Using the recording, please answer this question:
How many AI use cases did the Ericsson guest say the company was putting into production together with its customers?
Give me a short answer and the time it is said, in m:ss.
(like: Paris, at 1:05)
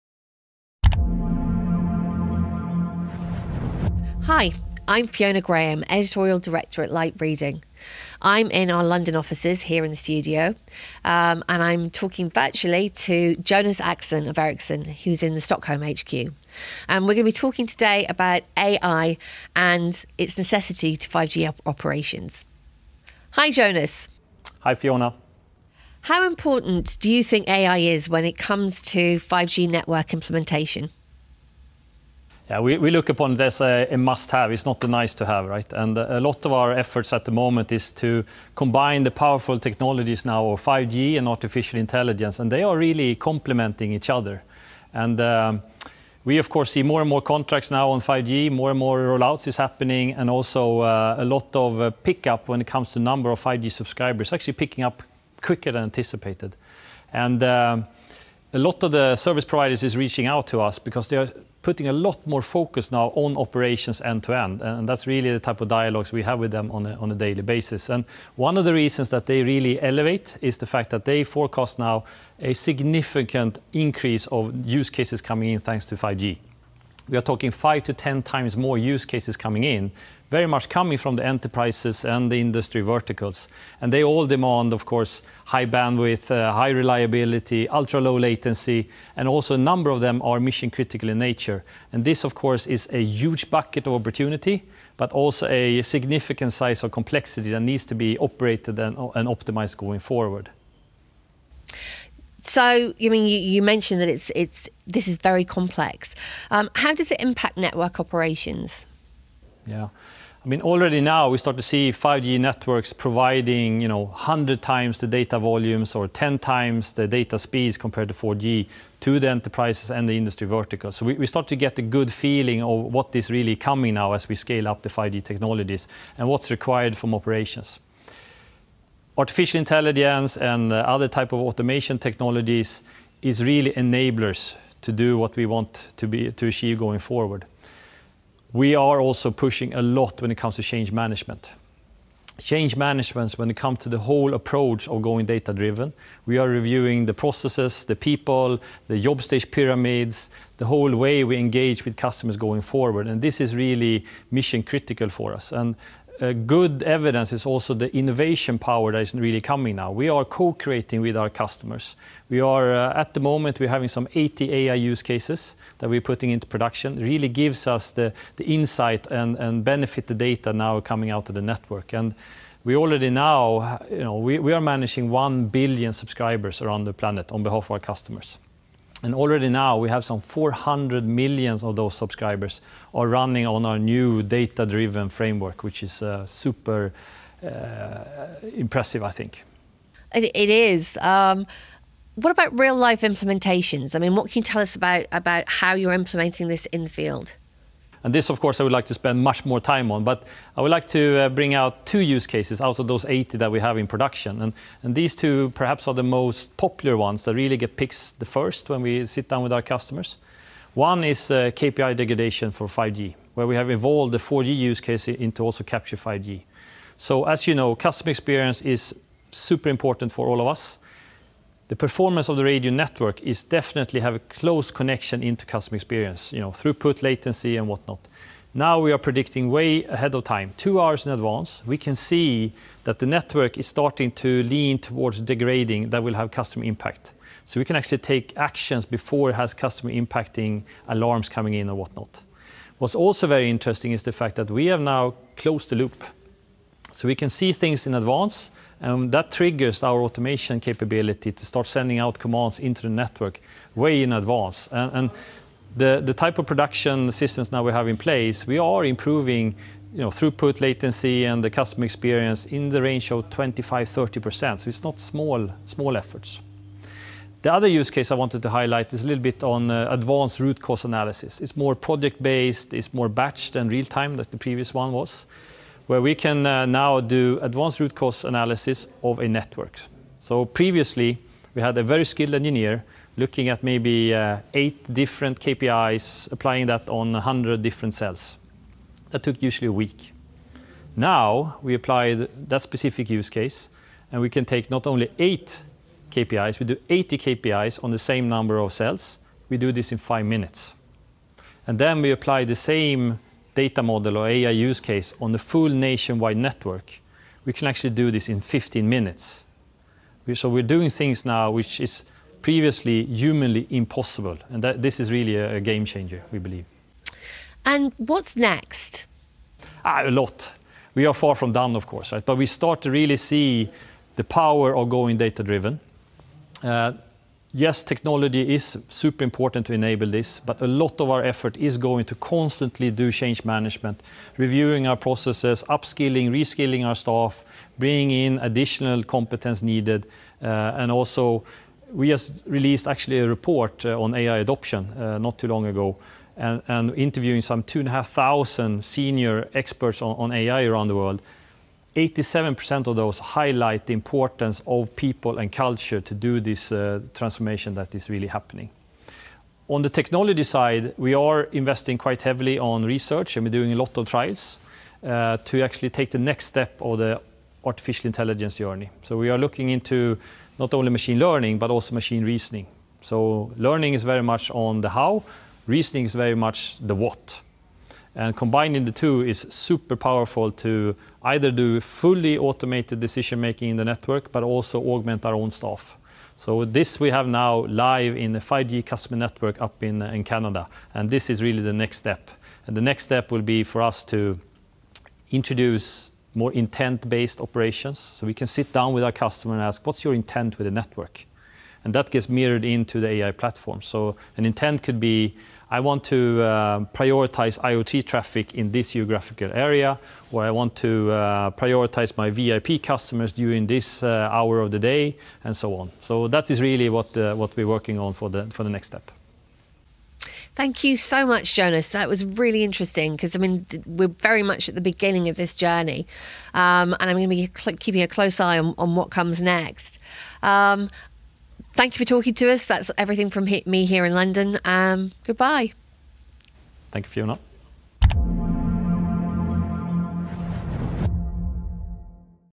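80, at 2:43.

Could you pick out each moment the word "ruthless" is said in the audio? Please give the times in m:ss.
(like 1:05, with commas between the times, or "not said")
not said.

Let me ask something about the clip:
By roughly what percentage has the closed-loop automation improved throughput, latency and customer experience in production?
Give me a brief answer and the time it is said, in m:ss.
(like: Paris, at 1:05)
25-30%, at 4:23.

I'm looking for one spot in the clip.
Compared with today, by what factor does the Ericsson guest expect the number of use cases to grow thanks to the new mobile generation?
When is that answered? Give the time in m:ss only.
1:17.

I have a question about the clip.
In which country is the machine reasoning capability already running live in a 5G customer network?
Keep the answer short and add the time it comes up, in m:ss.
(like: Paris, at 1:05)
Canada, at 6:30.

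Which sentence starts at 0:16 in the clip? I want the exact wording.
And we're going to be talking today about AI and its necessity to 5G operations.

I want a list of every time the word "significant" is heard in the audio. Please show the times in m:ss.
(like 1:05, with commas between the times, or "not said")
1:12, 1:35.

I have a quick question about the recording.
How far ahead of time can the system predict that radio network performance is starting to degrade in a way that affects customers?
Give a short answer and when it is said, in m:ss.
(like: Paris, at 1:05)
2 hours, at 3:50.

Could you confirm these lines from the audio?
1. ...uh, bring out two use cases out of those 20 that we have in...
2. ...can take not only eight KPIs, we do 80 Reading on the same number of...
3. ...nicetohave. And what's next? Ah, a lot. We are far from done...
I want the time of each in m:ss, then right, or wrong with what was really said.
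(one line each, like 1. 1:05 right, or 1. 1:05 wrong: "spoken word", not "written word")
1. 3:21 wrong: "80", not "20"
2. 4:54 wrong: "KPIs", not "Reading"
3. 5:16 wrong: "believe", not "nicetohave".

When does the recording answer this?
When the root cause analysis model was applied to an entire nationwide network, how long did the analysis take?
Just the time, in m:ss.
5:08.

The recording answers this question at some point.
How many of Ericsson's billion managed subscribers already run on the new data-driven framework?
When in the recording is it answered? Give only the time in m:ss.
3:00.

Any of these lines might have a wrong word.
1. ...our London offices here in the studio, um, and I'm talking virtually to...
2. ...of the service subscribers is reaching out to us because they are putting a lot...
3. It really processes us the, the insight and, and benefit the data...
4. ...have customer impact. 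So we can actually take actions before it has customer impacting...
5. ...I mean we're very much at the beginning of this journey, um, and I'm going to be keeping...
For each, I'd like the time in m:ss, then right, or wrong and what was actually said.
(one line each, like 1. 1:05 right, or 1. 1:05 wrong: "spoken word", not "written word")
1. 0:08 right
2. 0:58 wrong: "providers", not "subscribers"
3. 2:46 wrong: "gives", not "processes"
4. 3:56 right
5. 7:03 right.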